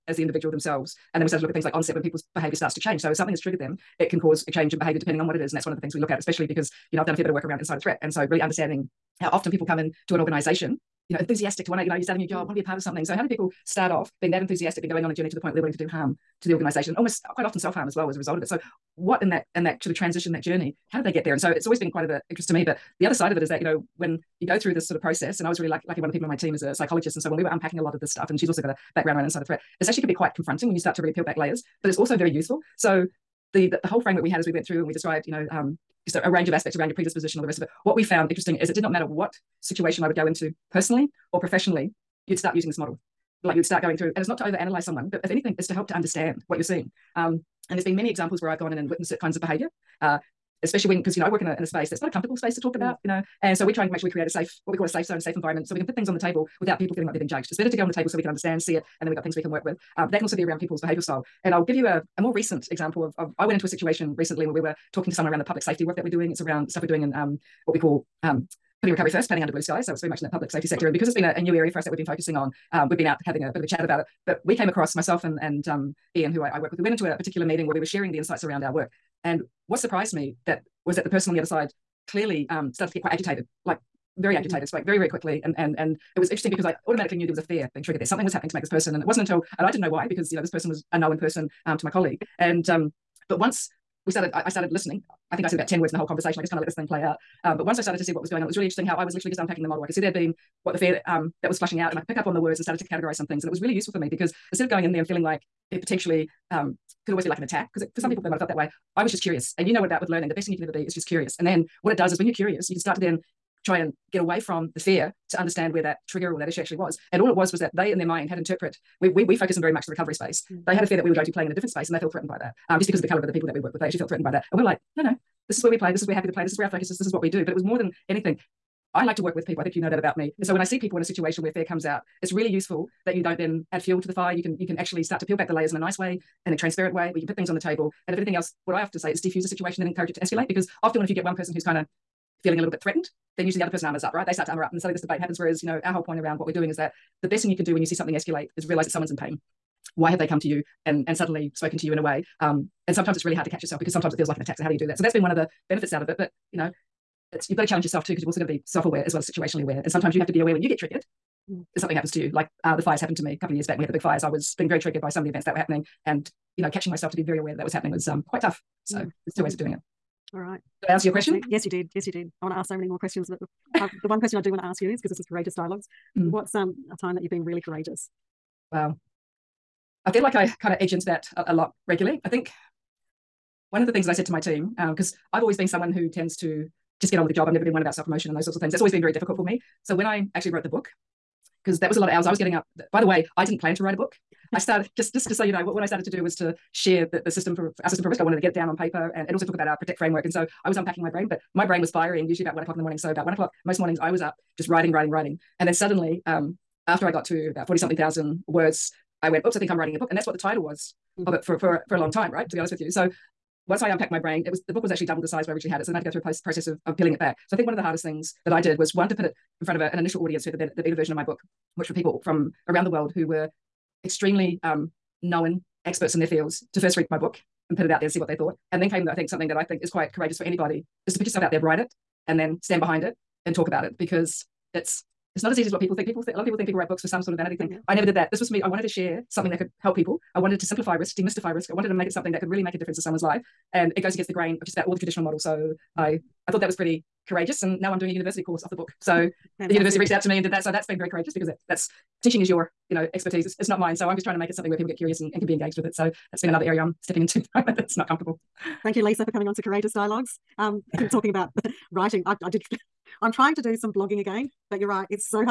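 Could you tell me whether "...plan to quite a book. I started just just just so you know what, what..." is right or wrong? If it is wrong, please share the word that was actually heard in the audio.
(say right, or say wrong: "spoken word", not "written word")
wrong: "write", not "quite".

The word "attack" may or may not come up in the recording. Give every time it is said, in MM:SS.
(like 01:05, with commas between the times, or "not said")
01:47, 02:34.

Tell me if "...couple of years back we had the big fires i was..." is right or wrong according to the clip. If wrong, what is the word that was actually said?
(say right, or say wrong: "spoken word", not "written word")
right.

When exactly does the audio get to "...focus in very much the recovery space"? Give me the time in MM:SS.
01:59.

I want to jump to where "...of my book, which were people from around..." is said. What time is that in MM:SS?
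03:41.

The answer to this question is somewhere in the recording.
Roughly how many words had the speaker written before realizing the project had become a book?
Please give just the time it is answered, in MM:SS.
03:27.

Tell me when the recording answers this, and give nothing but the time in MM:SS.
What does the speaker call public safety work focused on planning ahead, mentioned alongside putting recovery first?
01:09.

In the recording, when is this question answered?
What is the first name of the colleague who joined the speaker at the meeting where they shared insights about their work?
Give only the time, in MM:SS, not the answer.
01:16.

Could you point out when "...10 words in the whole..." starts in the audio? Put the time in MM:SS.
01:35.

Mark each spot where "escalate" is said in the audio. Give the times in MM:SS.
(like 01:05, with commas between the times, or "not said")
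02:20, 02:28.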